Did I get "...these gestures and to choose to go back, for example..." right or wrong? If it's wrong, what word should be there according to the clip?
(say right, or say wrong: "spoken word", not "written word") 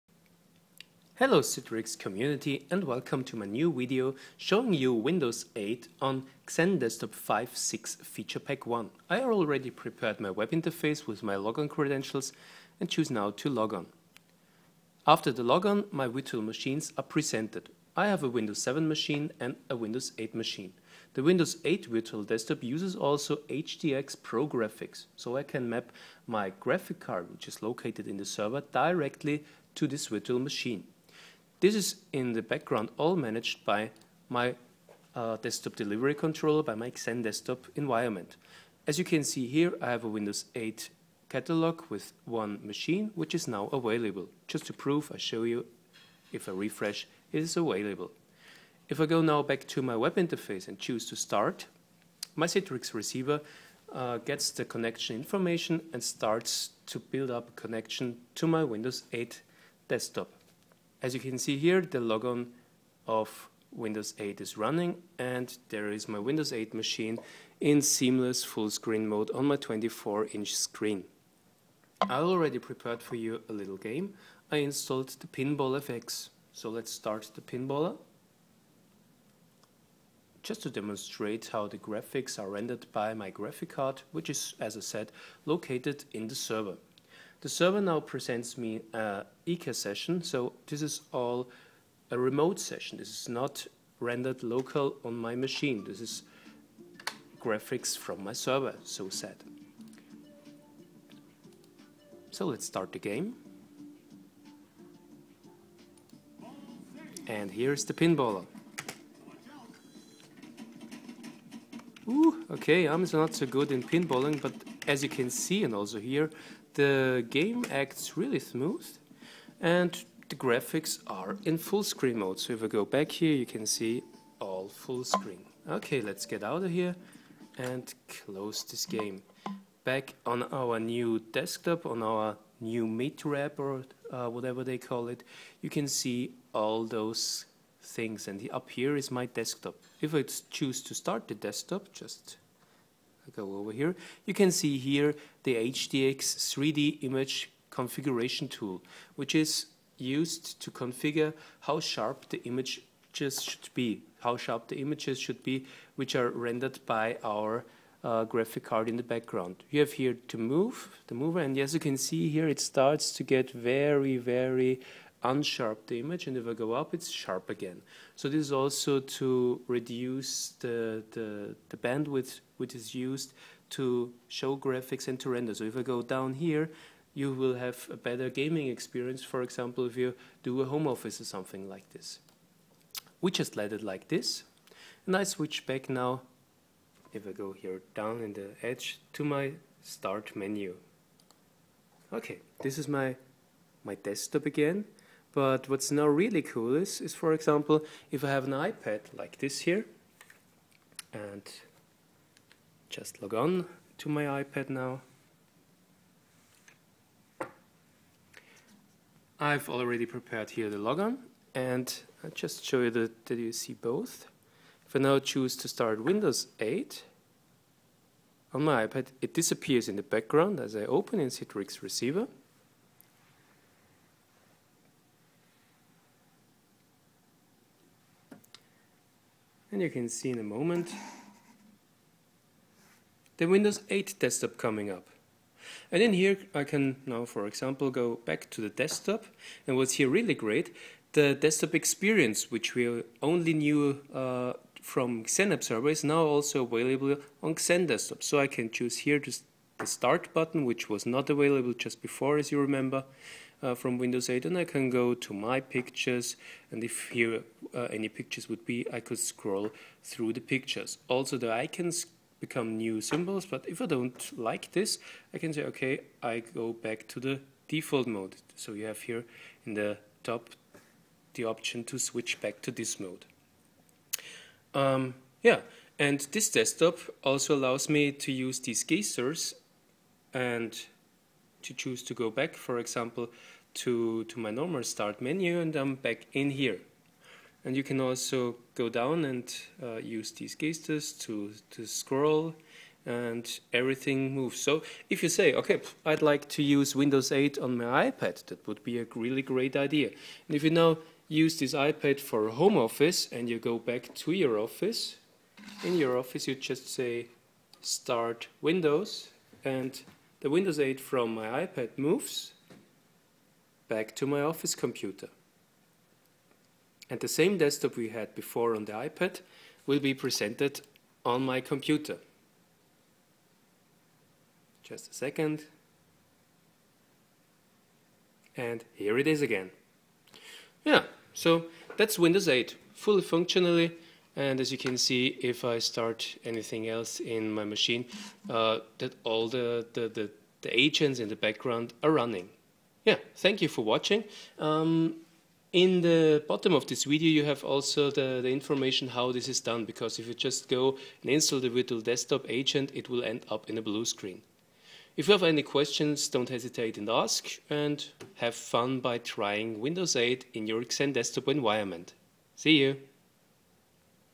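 right.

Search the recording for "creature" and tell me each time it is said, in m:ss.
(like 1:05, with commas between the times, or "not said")
not said.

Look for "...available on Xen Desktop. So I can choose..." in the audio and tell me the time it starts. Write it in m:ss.
4:06.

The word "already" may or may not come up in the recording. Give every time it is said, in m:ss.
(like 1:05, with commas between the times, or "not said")
0:09, 1:12, 3:29.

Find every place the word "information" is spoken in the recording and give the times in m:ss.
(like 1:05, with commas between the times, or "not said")
0:55, 5:48.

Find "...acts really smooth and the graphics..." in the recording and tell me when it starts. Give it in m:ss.
1:57.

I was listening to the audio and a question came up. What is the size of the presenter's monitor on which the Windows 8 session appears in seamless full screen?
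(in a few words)
24 inch.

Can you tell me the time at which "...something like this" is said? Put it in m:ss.
3:01.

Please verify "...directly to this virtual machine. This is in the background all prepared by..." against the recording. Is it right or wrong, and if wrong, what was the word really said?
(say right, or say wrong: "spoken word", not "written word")
wrong: "managed", not "prepared".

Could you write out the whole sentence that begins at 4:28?
So you have here in the top the option to switch back to this mode.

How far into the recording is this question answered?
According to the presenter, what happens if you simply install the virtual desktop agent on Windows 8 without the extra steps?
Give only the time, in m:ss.
5:53.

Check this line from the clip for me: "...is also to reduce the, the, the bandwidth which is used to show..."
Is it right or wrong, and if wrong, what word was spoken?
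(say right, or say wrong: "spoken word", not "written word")
right.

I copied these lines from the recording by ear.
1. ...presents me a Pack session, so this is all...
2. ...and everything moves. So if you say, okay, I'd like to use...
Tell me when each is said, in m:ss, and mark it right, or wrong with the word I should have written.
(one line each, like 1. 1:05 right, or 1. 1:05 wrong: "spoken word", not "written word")
1. 1:27 wrong: "ICA", not "Pack"
2. 4:53 right.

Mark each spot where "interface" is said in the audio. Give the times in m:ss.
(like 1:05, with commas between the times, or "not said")
0:10, 0:50.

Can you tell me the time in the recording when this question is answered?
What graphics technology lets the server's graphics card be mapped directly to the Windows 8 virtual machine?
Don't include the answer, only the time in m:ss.
0:23.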